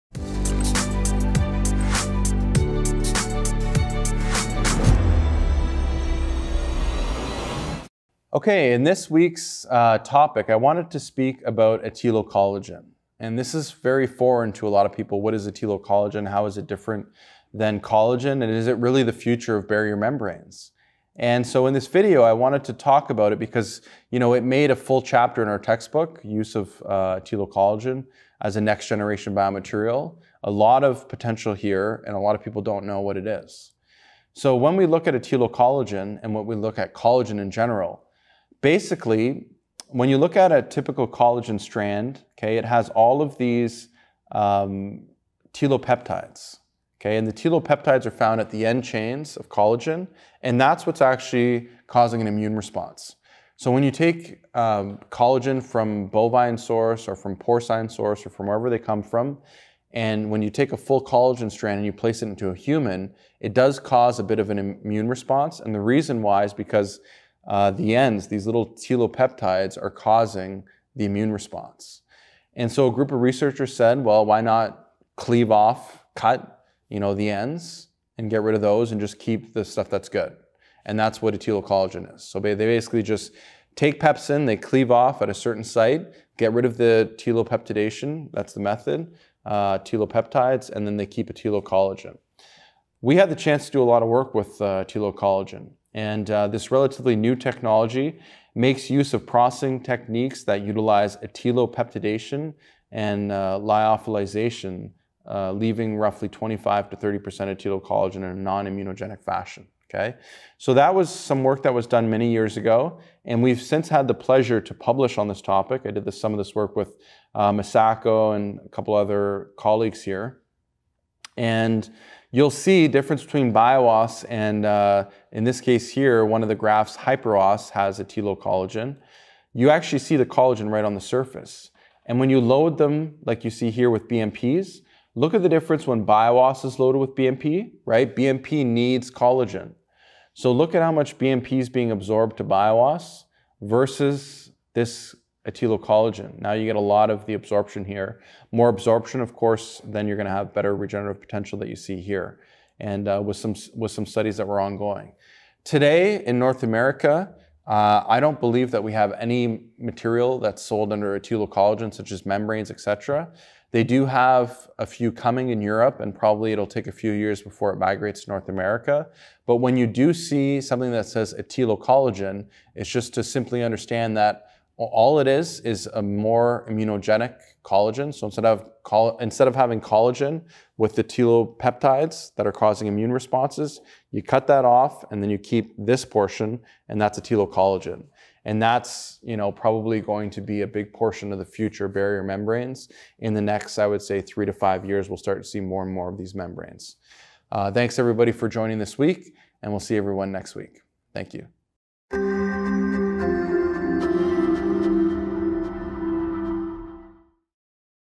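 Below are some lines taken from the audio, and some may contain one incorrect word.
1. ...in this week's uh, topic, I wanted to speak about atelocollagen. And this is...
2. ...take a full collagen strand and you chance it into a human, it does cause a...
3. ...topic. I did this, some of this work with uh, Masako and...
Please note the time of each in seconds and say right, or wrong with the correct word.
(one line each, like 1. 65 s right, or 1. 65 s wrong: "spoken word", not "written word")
1. 8 s right
2. 60 s wrong: "place", not "chance"
3. 115 s right.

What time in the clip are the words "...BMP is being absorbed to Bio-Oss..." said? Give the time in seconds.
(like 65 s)
141 s.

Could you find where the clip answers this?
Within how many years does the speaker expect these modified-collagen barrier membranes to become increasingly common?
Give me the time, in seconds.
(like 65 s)
194 s.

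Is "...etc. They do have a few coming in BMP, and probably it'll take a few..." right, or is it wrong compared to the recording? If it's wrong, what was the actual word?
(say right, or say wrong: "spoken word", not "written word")
wrong: "Europe", not "BMP".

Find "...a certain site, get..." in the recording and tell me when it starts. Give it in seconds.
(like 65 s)
85 s.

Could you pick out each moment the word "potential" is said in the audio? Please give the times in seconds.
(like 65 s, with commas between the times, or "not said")
31 s, 151 s.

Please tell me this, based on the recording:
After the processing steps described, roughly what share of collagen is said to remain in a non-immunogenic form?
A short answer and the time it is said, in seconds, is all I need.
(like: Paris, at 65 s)
25 to 30%, at 106 s.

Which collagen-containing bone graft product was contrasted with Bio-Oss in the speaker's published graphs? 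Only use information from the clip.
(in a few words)
Hypro-Oss.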